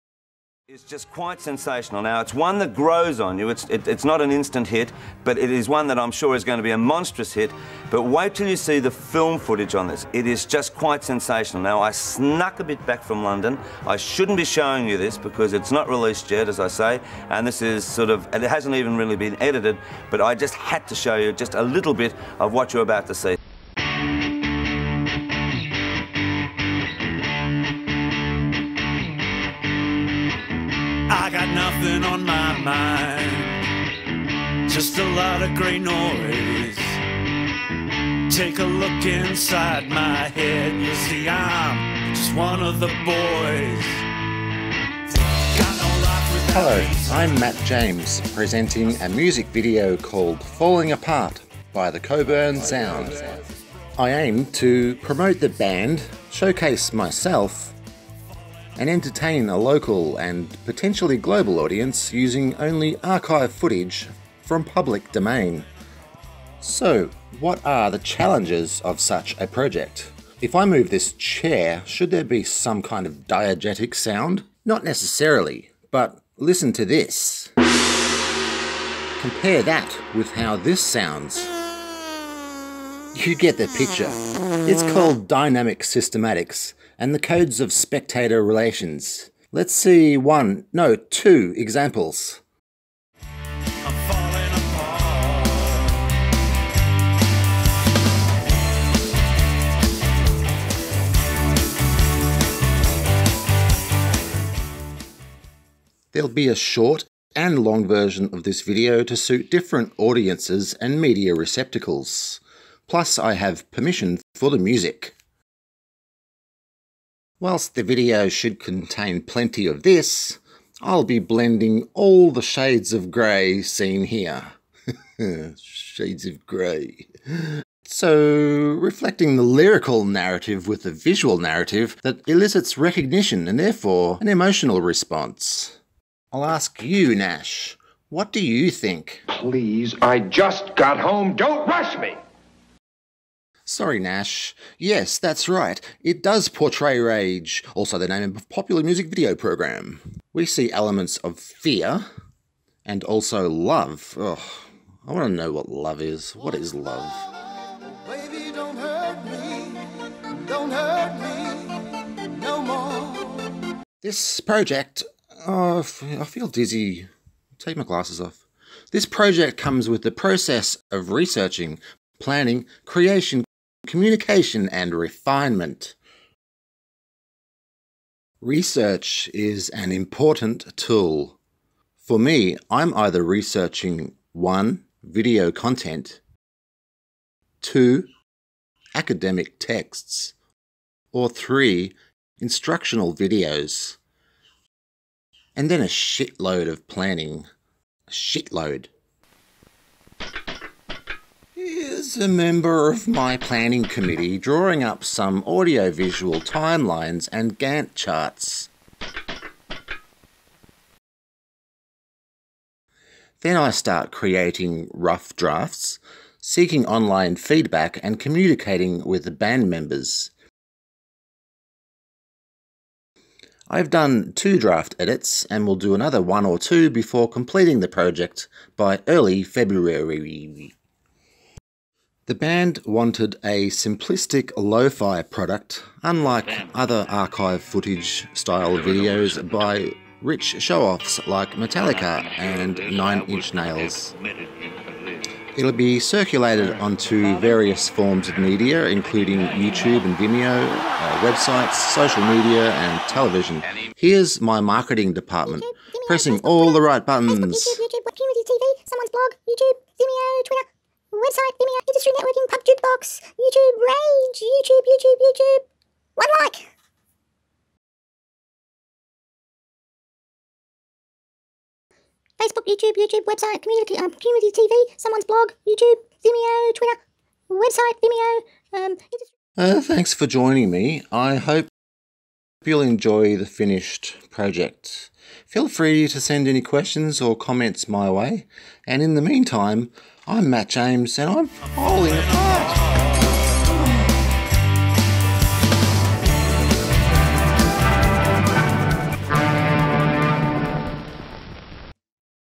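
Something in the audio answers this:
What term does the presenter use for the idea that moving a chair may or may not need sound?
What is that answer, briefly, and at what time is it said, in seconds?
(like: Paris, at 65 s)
Dynamic systematics, at 85 s.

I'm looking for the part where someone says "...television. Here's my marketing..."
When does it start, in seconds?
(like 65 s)
253 s.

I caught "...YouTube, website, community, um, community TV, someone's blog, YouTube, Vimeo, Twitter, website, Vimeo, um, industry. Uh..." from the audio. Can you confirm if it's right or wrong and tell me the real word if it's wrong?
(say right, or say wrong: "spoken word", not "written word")
right.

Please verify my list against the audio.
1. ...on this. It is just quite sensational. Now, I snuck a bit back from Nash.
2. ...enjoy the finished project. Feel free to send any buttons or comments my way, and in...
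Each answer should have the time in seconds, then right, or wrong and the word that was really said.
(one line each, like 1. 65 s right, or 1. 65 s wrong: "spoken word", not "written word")
1. 9 s wrong: "London", not "Nash"
2. 282 s wrong: "questions", not "buttons".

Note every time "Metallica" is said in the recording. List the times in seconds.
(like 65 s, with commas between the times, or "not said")
241 s.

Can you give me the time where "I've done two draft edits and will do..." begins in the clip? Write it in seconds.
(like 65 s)
223 s.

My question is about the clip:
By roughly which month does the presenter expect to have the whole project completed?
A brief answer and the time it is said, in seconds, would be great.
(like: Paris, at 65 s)
Early February, at 229 s.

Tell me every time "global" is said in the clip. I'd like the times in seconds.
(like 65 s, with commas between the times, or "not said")
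61 s.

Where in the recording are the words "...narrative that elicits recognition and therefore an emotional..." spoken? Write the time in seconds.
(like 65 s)
131 s.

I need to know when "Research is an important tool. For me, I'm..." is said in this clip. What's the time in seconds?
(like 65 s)
178 s.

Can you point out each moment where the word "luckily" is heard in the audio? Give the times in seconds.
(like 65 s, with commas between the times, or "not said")
not said.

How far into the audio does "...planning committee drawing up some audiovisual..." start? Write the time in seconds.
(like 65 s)
203 s.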